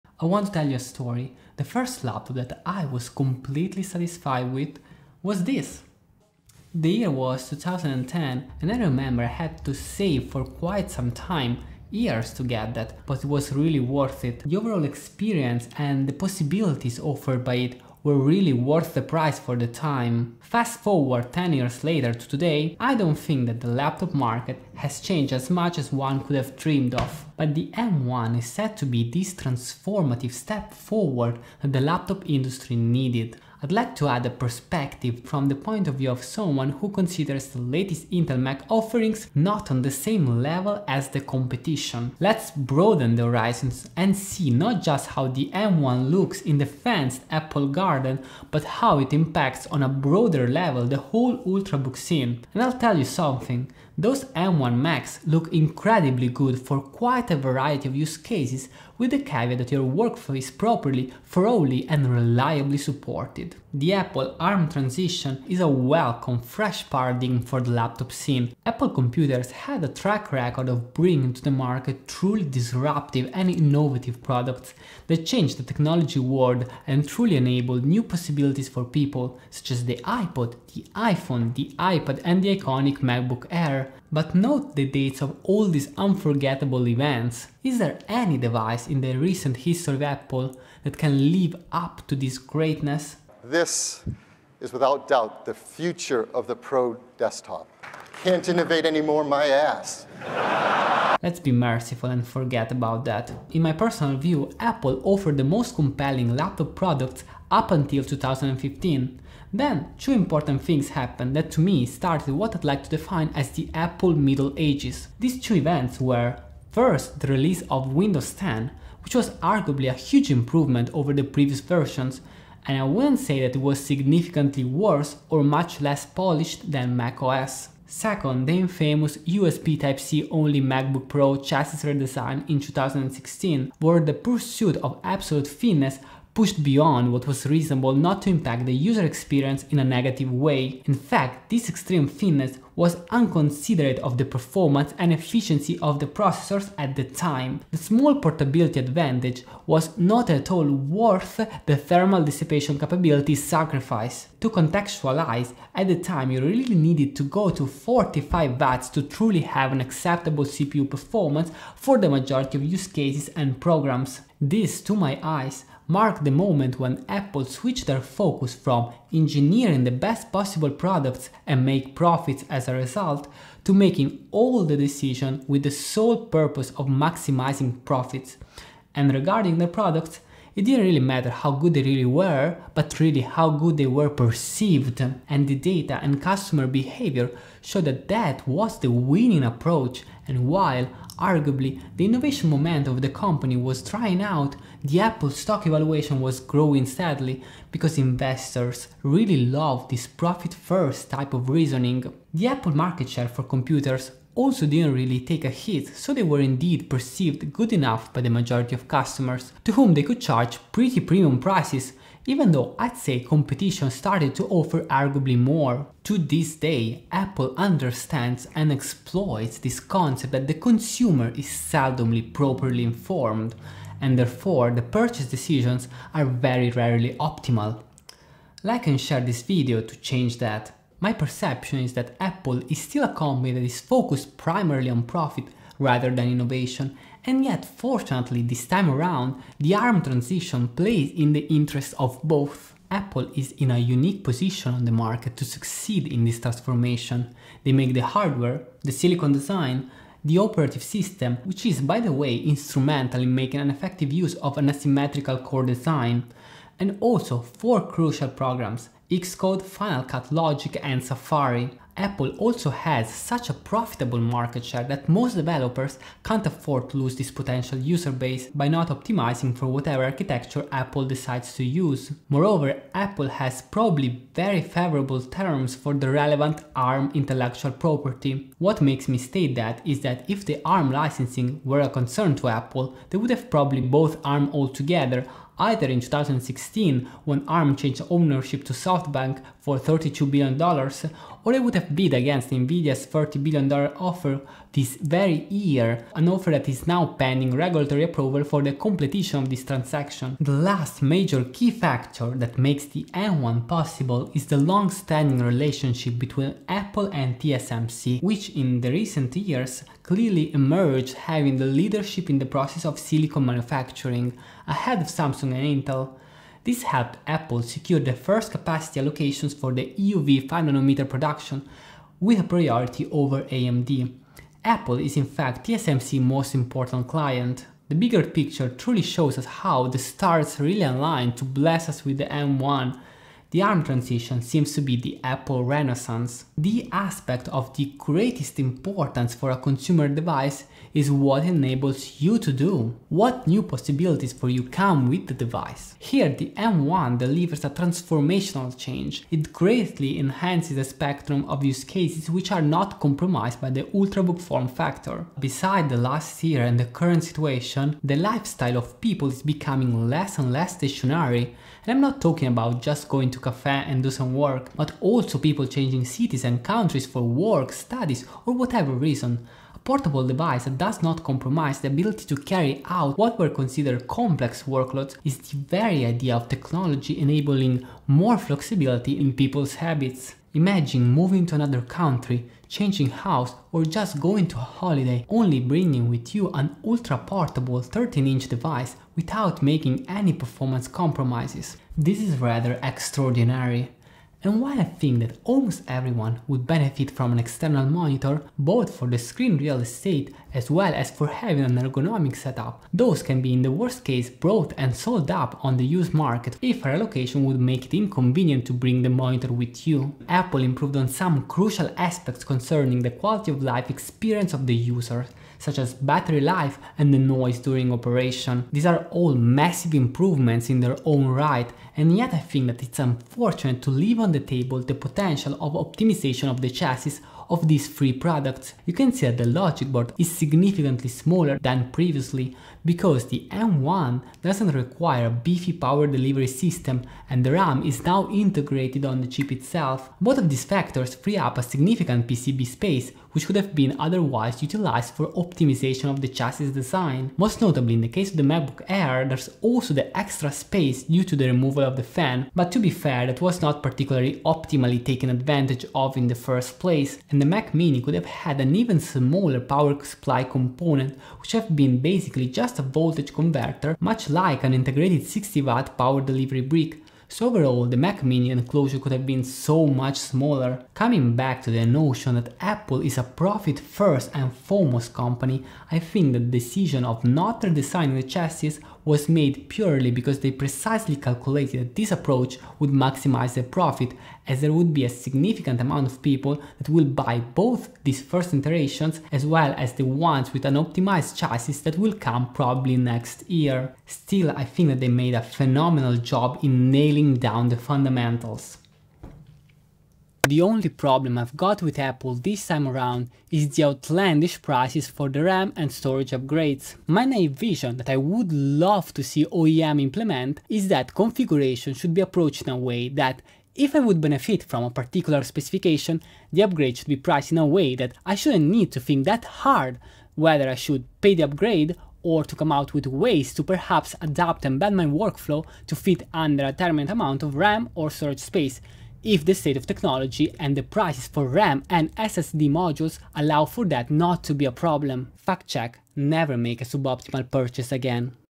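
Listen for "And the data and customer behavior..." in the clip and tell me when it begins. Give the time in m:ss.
3:05.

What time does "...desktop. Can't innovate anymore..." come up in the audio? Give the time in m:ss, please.
1:37.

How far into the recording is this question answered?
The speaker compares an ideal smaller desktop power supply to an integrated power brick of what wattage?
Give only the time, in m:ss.
7:45.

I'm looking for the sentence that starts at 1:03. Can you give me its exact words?
The Apple ARM transition is a welcome fresh paradigm for the laptop scene.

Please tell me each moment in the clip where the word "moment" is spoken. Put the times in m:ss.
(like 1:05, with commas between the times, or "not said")
2:46, 3:12.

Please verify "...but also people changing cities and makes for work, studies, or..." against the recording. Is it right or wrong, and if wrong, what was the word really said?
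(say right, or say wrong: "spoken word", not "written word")
wrong: "countries", not "makes".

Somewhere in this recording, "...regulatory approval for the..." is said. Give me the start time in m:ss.
4:57.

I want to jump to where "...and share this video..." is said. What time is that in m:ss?
3:48.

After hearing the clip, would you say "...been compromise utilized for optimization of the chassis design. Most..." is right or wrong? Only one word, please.
wrong.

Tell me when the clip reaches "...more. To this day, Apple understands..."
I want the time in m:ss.
3:35.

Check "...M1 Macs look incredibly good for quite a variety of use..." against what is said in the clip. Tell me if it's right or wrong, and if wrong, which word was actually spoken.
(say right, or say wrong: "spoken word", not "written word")
right.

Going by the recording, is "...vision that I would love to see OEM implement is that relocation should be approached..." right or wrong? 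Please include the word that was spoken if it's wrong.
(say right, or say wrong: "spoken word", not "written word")
wrong: "configuration", not "relocation".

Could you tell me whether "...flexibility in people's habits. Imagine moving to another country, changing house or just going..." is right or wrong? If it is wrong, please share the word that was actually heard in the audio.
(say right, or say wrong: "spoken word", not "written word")
right.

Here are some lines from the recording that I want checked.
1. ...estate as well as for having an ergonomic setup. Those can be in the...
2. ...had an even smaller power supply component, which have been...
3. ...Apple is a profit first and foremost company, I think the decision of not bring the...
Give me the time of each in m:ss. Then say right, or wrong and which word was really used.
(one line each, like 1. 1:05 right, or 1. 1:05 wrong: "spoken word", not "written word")
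1. 6:39 right
2. 7:38 right
3. 7:52 wrong: "redesigning", not "bring".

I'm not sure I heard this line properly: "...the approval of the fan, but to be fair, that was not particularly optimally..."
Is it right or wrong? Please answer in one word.
wrong.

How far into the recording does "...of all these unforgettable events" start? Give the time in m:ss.
1:25.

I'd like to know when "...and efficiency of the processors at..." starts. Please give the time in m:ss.
2:24.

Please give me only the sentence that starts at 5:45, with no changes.
Here the M1 delivers a transformational change.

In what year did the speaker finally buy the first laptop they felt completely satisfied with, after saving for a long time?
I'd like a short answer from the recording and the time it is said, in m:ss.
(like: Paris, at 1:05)
2010, at 0:07.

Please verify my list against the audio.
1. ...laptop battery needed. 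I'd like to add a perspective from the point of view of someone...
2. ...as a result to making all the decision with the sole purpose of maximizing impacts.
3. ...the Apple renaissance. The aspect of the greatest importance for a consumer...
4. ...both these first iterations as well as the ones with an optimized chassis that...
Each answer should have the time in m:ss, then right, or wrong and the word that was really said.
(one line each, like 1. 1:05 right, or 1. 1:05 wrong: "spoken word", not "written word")
1. 0:31 wrong: "industry", not "battery"
2. 2:52 wrong: "profits", not "impacts"
3. 5:34 right
4. 8:07 right.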